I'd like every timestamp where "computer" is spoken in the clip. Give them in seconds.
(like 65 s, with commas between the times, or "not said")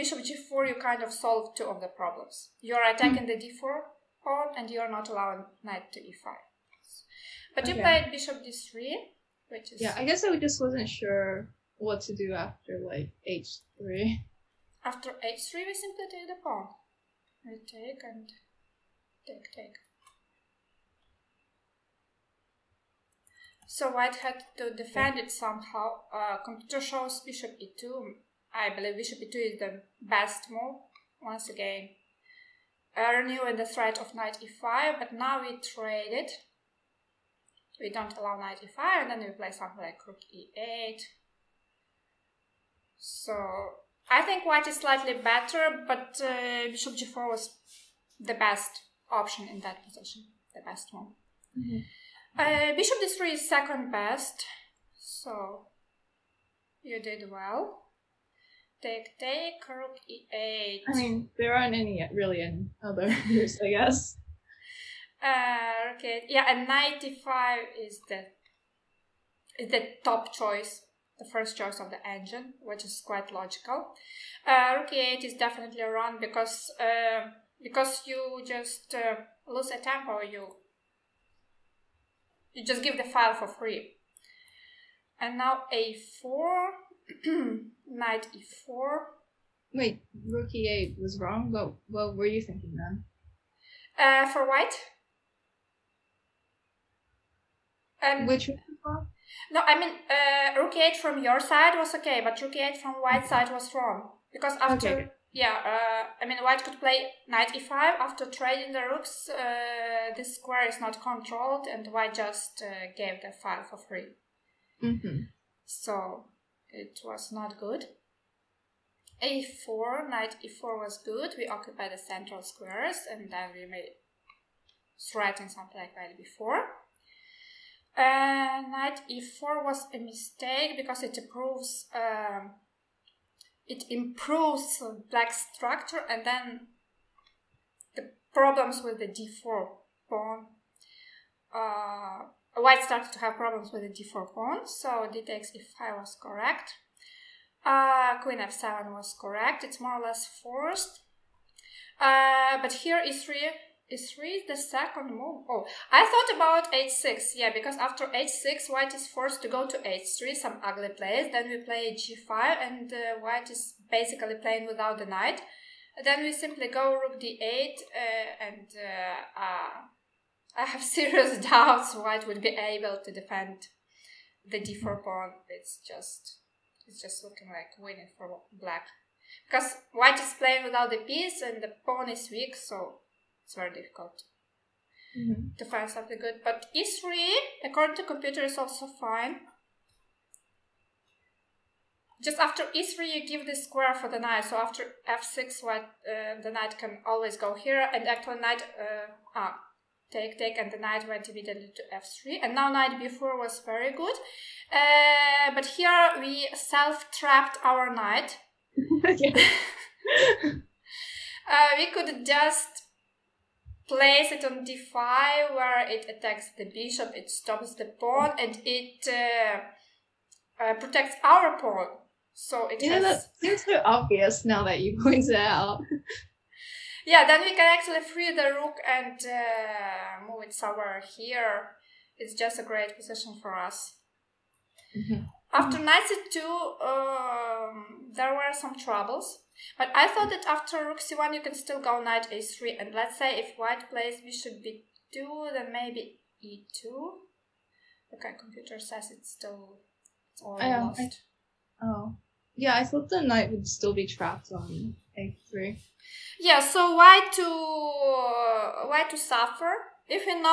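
26 s, 188 s, 248 s.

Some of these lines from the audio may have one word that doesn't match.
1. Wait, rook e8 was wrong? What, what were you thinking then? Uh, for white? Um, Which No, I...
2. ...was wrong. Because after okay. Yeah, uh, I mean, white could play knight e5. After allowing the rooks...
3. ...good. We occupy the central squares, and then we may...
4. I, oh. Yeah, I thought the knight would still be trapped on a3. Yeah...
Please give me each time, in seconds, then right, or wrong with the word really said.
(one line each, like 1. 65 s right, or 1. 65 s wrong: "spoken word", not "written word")
1. 89 s right
2. 103 s wrong: "trading", not "allowing"
3. 121 s right
4. 251 s right.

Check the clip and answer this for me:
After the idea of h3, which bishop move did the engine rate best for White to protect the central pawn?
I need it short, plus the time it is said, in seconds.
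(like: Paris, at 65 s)
Bishop e2, at 27 s.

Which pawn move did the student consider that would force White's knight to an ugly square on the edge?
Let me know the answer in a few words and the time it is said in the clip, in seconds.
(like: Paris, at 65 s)
h6, at 155 s.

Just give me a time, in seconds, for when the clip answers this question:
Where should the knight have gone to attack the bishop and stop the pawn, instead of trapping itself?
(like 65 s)
214 s.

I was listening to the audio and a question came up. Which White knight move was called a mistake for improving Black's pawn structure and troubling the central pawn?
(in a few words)
Knight e4.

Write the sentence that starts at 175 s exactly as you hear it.
It's just, it's just looking like winning for black.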